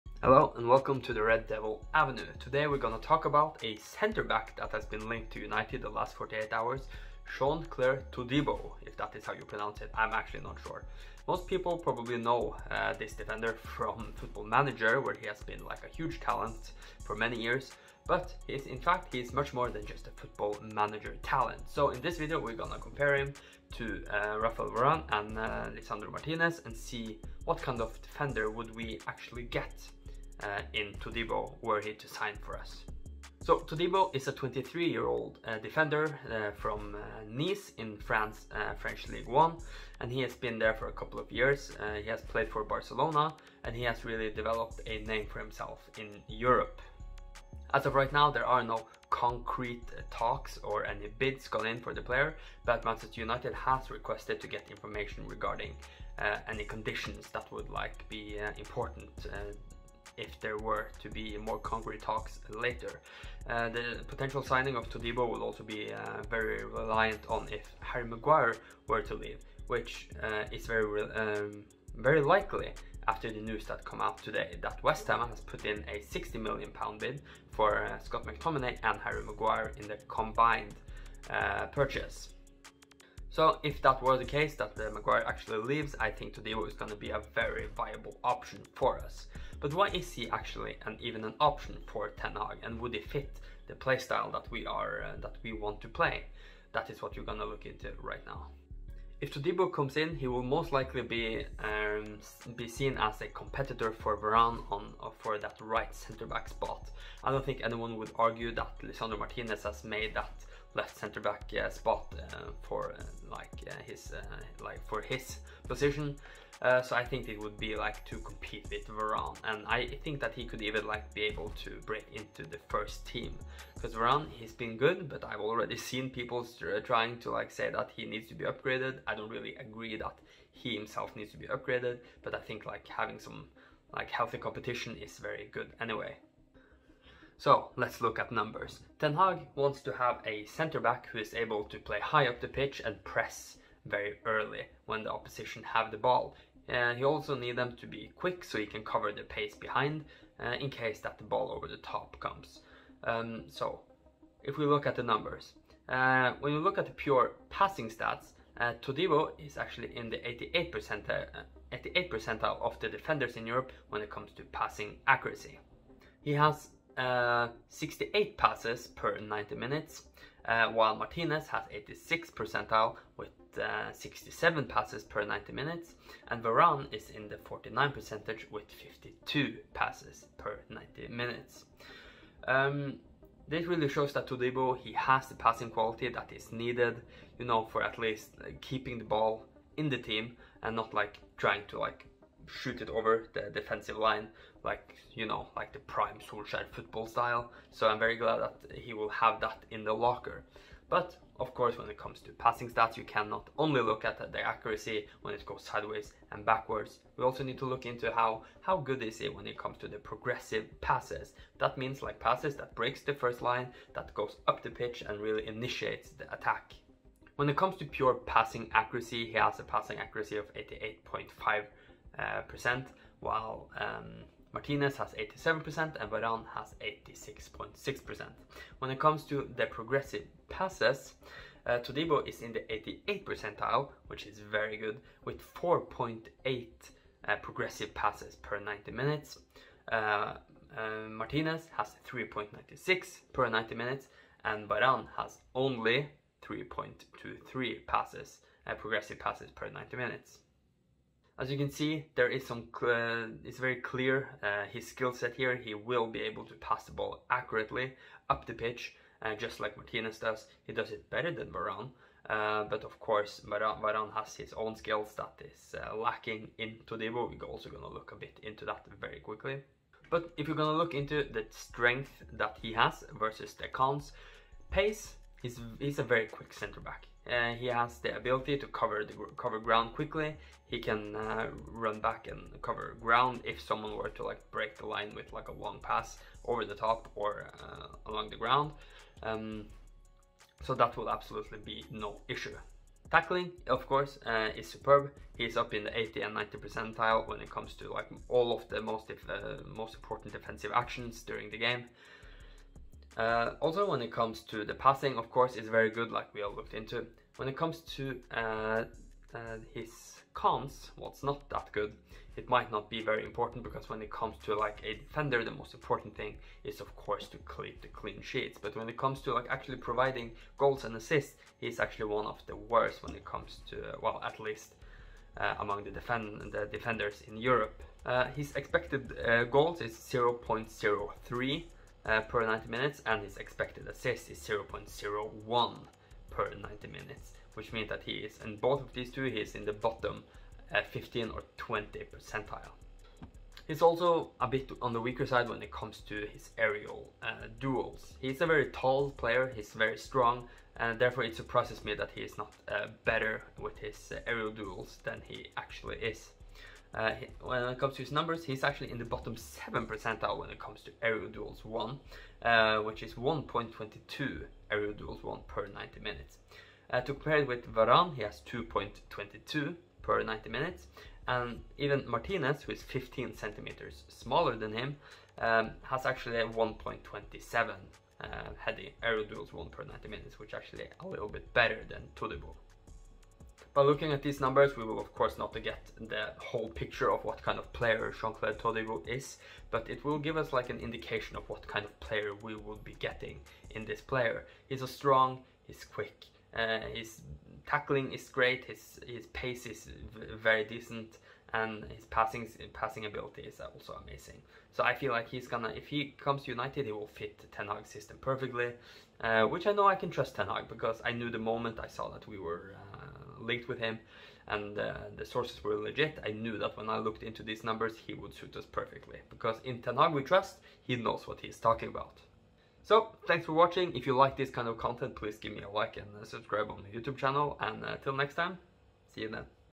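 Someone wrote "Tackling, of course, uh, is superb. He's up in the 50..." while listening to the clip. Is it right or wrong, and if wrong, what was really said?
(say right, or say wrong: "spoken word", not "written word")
wrong: "80", not "50".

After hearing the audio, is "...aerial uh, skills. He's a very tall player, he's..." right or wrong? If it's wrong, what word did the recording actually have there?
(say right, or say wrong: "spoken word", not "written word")
wrong: "duels", not "skills".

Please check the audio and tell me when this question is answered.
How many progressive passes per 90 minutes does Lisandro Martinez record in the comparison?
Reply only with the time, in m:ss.
4:02.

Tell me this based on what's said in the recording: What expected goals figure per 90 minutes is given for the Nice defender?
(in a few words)
0.03.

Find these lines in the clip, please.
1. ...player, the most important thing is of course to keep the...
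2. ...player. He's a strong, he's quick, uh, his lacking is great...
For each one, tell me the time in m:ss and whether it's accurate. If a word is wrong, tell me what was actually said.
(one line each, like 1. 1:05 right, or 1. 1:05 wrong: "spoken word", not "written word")
1. 5:14 wrong: "defender", not "player"
2. 6:34 wrong: "tackling", not "lacking".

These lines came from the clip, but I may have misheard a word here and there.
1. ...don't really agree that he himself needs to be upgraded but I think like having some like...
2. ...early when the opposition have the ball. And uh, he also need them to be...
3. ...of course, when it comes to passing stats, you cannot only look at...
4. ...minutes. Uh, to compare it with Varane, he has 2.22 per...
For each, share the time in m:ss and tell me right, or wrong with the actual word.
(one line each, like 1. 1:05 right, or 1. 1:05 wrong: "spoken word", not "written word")
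1. 2:09 right
2. 2:24 right
3. 3:21 right
4. 6:06 right.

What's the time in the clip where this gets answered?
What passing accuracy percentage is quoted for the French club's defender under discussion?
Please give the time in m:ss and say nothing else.
3:40.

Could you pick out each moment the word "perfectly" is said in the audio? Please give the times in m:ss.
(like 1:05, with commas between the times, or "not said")
6:48, 6:58.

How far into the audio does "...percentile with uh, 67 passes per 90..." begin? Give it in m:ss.
2:52.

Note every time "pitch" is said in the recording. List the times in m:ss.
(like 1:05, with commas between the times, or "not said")
2:22, 3:34, 4:18.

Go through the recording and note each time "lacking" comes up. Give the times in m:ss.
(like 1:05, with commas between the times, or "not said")
4:25.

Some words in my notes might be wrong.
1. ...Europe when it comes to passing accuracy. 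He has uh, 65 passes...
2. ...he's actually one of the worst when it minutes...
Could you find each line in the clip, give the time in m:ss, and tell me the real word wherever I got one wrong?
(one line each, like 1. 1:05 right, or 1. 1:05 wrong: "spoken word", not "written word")
1. 2:43 wrong: "68", not "65"
2. 5:21 wrong: "comes", not "minutes".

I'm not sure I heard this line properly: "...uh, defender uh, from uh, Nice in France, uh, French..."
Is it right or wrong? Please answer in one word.
right.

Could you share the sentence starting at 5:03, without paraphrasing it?
Uh, also, when it comes to the passing, of course, is very good, like we all looked into.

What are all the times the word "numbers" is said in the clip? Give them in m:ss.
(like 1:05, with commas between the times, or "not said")
2:18, 2:35, 5:58, 6:24, 6:57.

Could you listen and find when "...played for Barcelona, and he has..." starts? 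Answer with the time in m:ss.
0:42.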